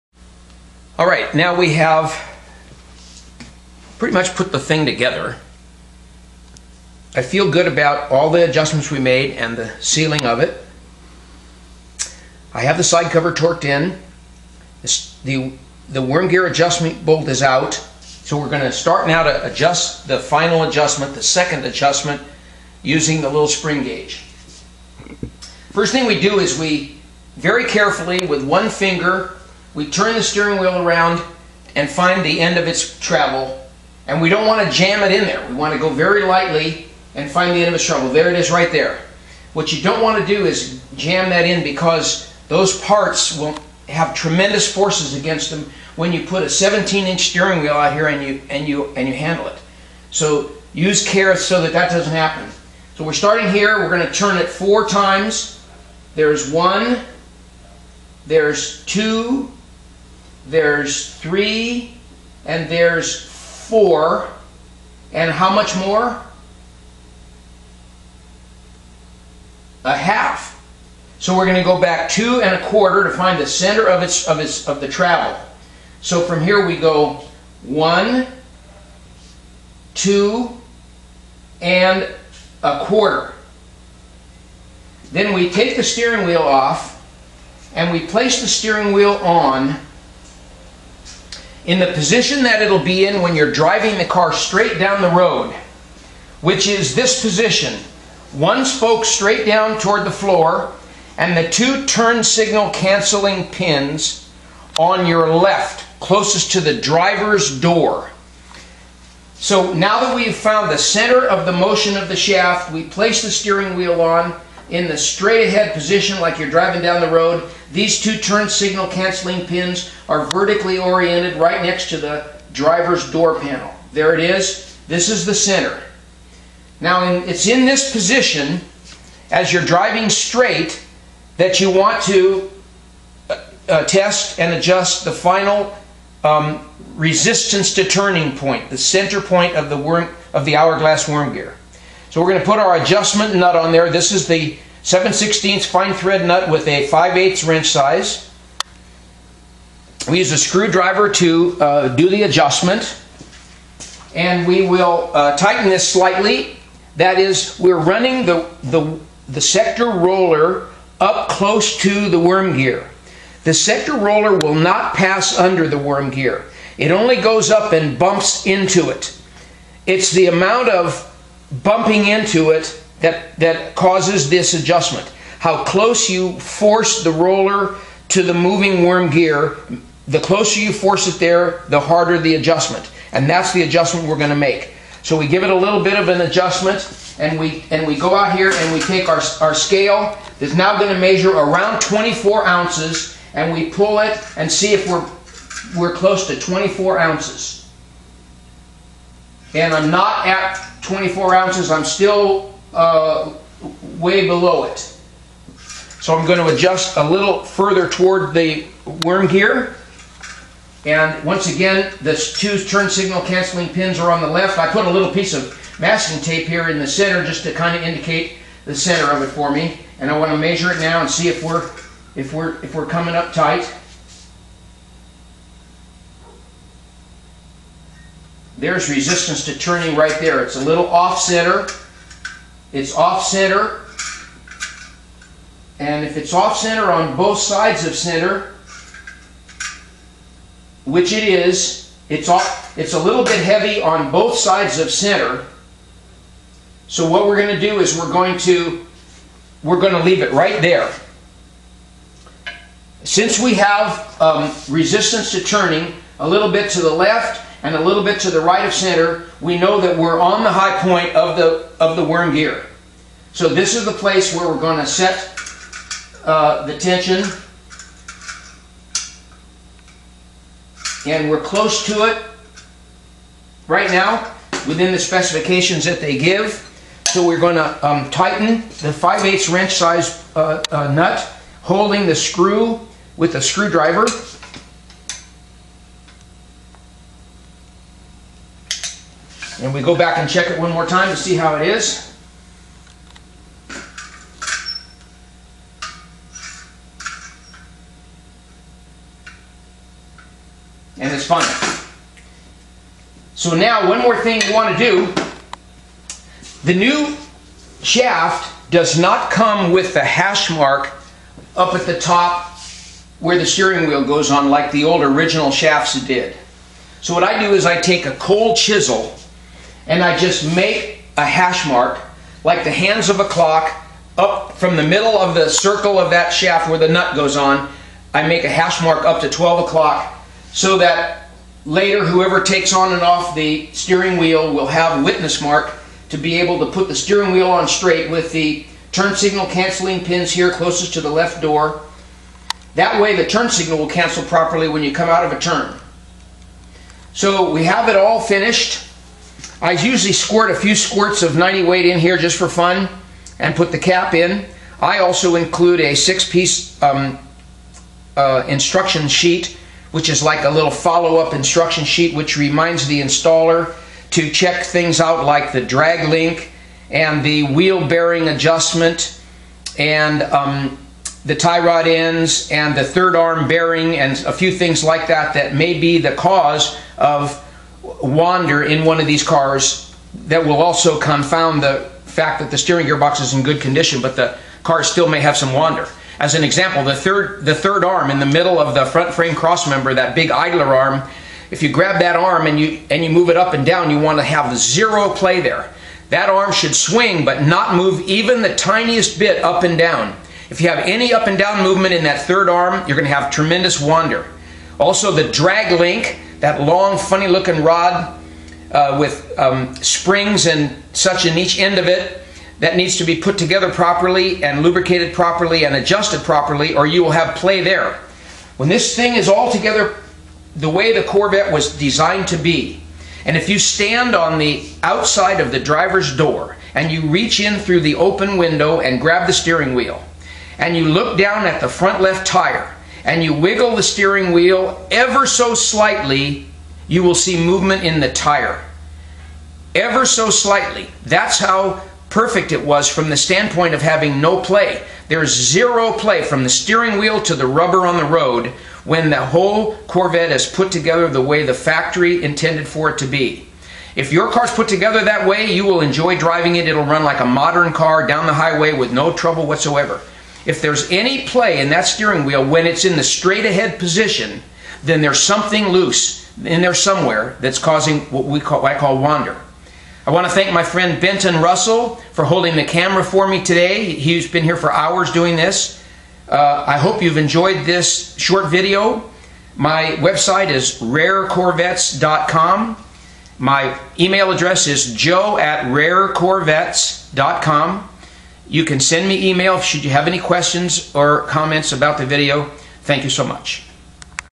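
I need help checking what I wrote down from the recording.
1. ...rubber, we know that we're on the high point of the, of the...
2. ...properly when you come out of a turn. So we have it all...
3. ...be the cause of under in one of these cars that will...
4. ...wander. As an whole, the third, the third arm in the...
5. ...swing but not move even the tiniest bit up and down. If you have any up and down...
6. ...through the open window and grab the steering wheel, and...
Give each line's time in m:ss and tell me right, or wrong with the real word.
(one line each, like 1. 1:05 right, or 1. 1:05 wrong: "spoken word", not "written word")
1. 4:18 wrong: "center", not "rubber"
2. 5:44 right
3. 6:15 wrong: "wander", not "under"
4. 6:25 wrong: "example", not "whole"
5. 6:36 right
6. 7:07 right.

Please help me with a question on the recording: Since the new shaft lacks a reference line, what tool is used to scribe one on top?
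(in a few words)
cold chisel.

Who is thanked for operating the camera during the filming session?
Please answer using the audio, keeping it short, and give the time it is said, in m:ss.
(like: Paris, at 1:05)
Benton Russell, at 7:50.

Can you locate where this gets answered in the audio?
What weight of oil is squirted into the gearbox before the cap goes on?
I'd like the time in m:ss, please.
5:51.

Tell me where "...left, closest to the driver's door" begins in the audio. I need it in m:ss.
1:45.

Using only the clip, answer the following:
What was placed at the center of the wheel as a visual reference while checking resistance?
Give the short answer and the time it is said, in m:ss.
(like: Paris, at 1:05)
masking tape, at 3:35.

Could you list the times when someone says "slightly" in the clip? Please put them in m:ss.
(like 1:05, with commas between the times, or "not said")
2:35, 7:15, 7:20.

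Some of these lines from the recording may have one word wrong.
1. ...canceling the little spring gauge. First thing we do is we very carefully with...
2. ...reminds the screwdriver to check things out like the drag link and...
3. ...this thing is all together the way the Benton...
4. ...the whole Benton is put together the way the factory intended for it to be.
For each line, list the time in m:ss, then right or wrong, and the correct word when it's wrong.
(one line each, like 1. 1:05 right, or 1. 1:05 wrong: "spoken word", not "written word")
1. 0:22 wrong: "using", not "canceling"
2. 6:02 wrong: "installer", not "screwdriver"
3. 6:58 wrong: "Corvette", not "Benton"
4. 7:29 wrong: "Corvette", not "Benton".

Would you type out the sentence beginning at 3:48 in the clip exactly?
There's resistance to turning right there.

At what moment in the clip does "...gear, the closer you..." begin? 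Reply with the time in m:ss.
2:59.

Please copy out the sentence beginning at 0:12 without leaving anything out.
I have the side cover torqued in.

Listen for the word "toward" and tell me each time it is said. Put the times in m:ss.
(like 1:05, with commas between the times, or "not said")
1:39, 3:27.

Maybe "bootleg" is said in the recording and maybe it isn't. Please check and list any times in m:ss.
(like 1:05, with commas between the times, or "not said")
not said.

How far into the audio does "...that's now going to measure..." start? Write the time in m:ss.
3:10.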